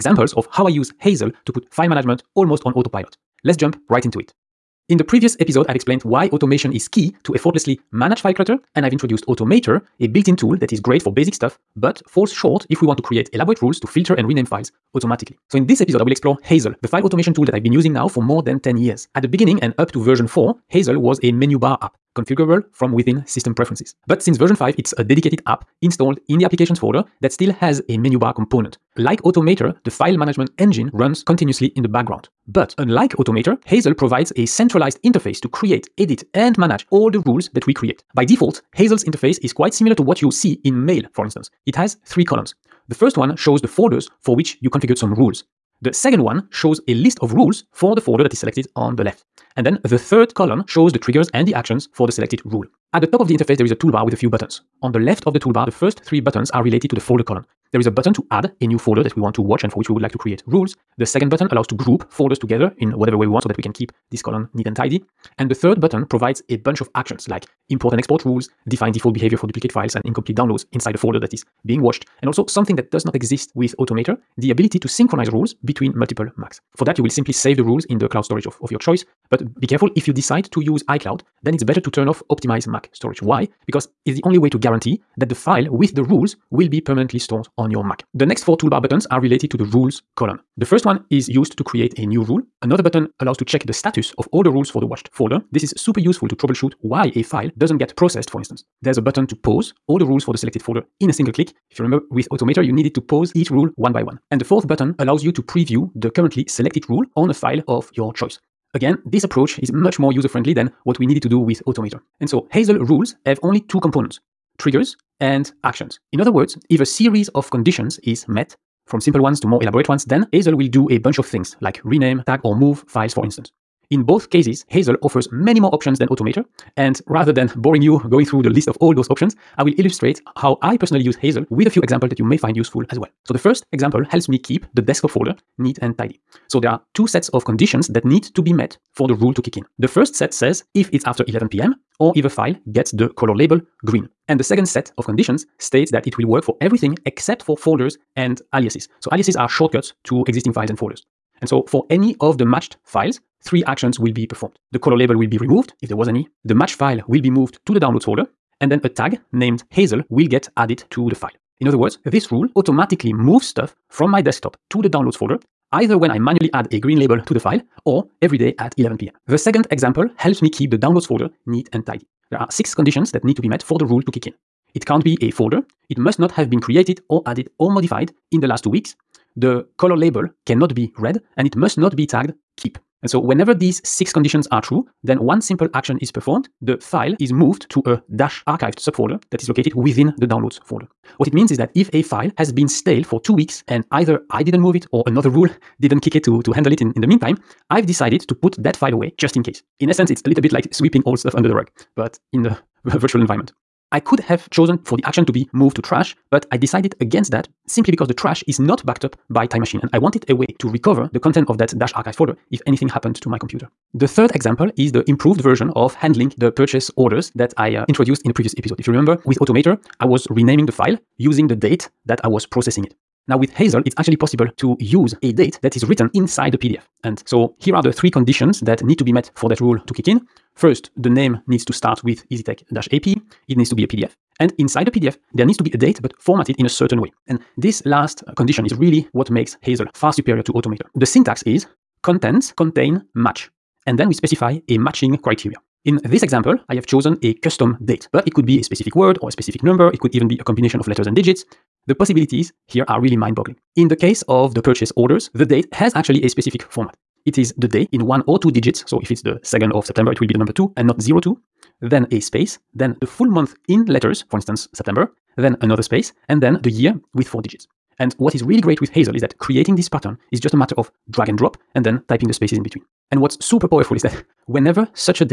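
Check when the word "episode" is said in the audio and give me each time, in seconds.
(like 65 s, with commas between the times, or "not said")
5 s, 15 s, 218 s.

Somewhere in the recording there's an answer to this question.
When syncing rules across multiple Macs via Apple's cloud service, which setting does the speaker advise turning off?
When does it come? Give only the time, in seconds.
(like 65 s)
82 s.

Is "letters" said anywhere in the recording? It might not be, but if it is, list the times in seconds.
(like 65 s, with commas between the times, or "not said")
250 s, 263 s.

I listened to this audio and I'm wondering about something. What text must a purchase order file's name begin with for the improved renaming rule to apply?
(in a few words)
EasyTech-AP.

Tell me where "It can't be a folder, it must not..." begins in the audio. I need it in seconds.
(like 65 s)
174 s.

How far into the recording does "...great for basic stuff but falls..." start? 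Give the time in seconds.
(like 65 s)
10 s.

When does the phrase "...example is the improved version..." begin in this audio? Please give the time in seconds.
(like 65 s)
214 s.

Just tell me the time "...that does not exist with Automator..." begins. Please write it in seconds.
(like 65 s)
72 s.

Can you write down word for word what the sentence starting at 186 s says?
The file is moved to a dash archived subfolder that is located within the downloads folder.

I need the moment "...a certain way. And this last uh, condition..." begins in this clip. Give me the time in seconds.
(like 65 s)
236 s.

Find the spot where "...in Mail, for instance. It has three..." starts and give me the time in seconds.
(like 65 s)
40 s.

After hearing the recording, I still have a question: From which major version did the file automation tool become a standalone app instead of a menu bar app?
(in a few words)
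5.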